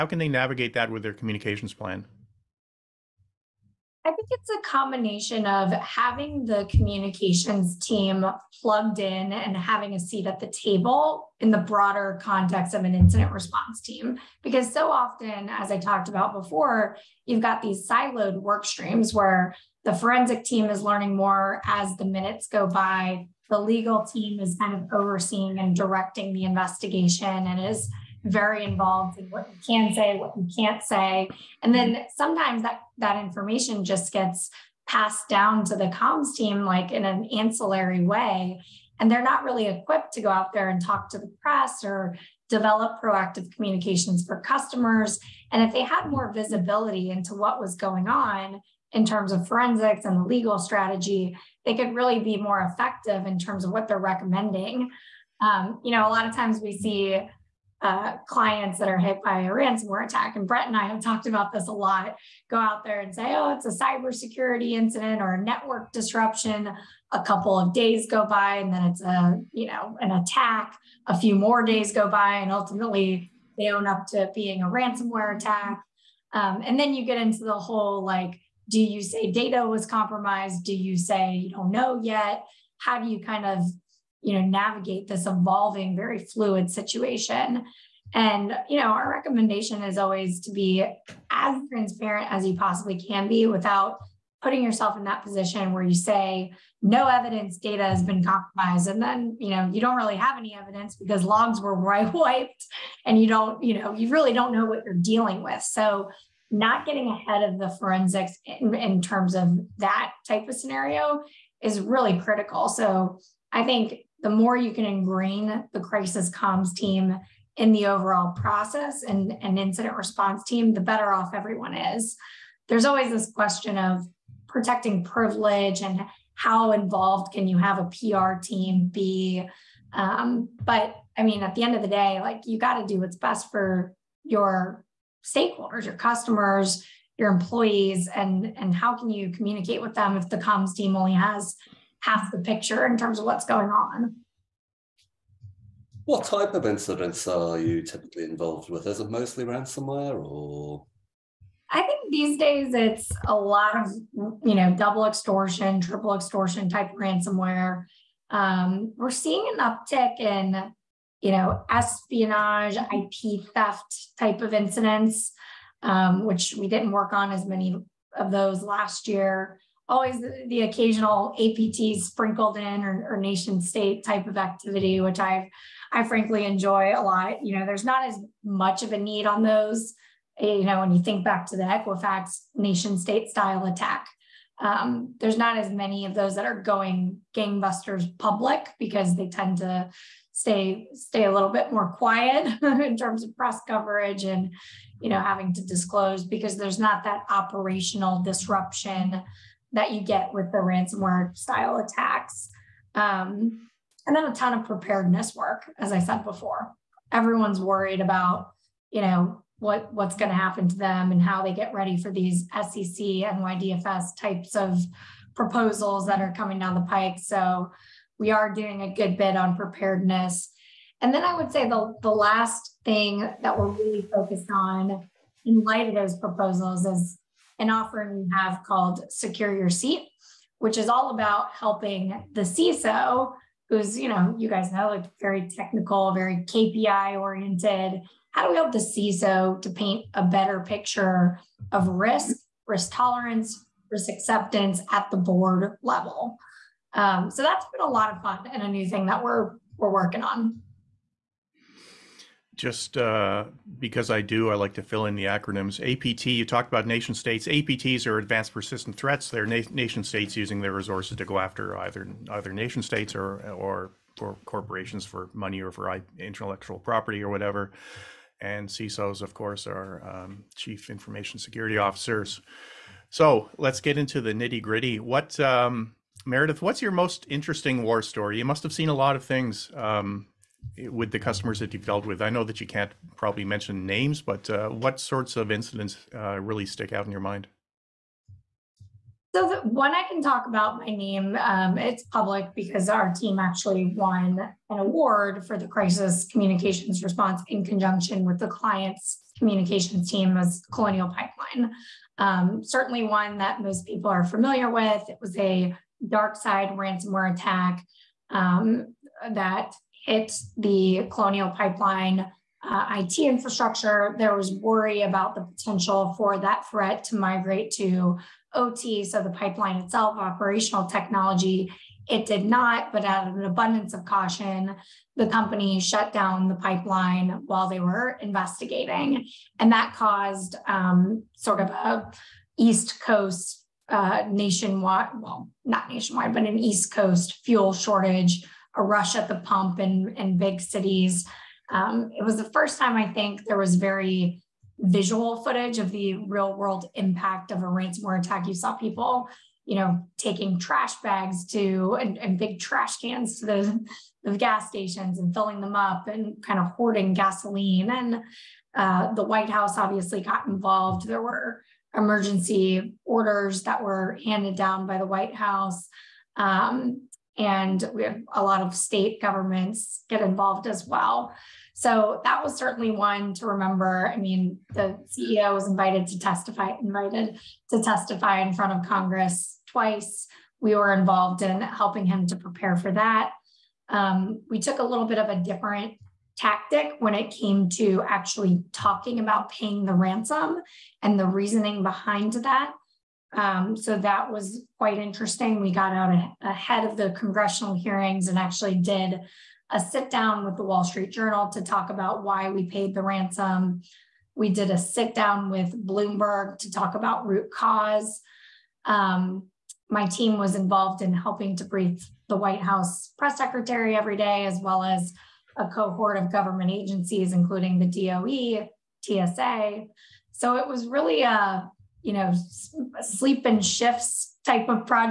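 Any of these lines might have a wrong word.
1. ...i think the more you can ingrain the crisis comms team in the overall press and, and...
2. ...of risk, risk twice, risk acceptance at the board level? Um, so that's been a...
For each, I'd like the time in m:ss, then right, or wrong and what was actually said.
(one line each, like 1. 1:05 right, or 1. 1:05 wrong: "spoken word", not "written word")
1. 1:53 wrong: "process", not "press"
2. 4:01 wrong: "tolerance", not "twice".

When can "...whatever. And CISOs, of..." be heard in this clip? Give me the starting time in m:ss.
4:27.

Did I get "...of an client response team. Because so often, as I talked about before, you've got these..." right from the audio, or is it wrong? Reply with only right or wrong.
wrong.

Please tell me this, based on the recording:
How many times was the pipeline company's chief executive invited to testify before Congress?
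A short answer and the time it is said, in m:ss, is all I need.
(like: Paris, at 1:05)
2, at 6:19.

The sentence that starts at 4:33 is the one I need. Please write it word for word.
So let's get into the nitty gritty.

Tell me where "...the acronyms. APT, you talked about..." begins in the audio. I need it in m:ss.
4:15.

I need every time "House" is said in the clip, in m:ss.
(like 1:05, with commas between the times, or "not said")
5:59, 6:05, 6:52.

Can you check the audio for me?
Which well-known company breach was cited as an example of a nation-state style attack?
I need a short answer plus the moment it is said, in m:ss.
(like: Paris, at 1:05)
Equifax, at 3:01.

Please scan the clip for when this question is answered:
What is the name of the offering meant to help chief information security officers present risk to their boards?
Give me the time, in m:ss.
3:49.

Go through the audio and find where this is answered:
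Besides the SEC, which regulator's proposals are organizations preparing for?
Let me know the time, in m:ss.
3:33.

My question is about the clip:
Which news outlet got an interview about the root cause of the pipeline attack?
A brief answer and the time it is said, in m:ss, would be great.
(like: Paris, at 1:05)
Bloomberg, at 6:45.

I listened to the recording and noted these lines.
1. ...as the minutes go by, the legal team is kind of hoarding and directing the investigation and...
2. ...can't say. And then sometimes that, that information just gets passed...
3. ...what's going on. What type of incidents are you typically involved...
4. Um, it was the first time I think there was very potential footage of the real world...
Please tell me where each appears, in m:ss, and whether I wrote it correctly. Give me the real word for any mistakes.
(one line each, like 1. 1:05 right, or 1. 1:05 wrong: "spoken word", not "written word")
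1. 0:21 wrong: "overseeing", not "hoarding"
2. 0:30 right
3. 2:23 right
4. 5:41 wrong: "visual", not "potential".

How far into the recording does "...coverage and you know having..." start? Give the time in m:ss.
3:13.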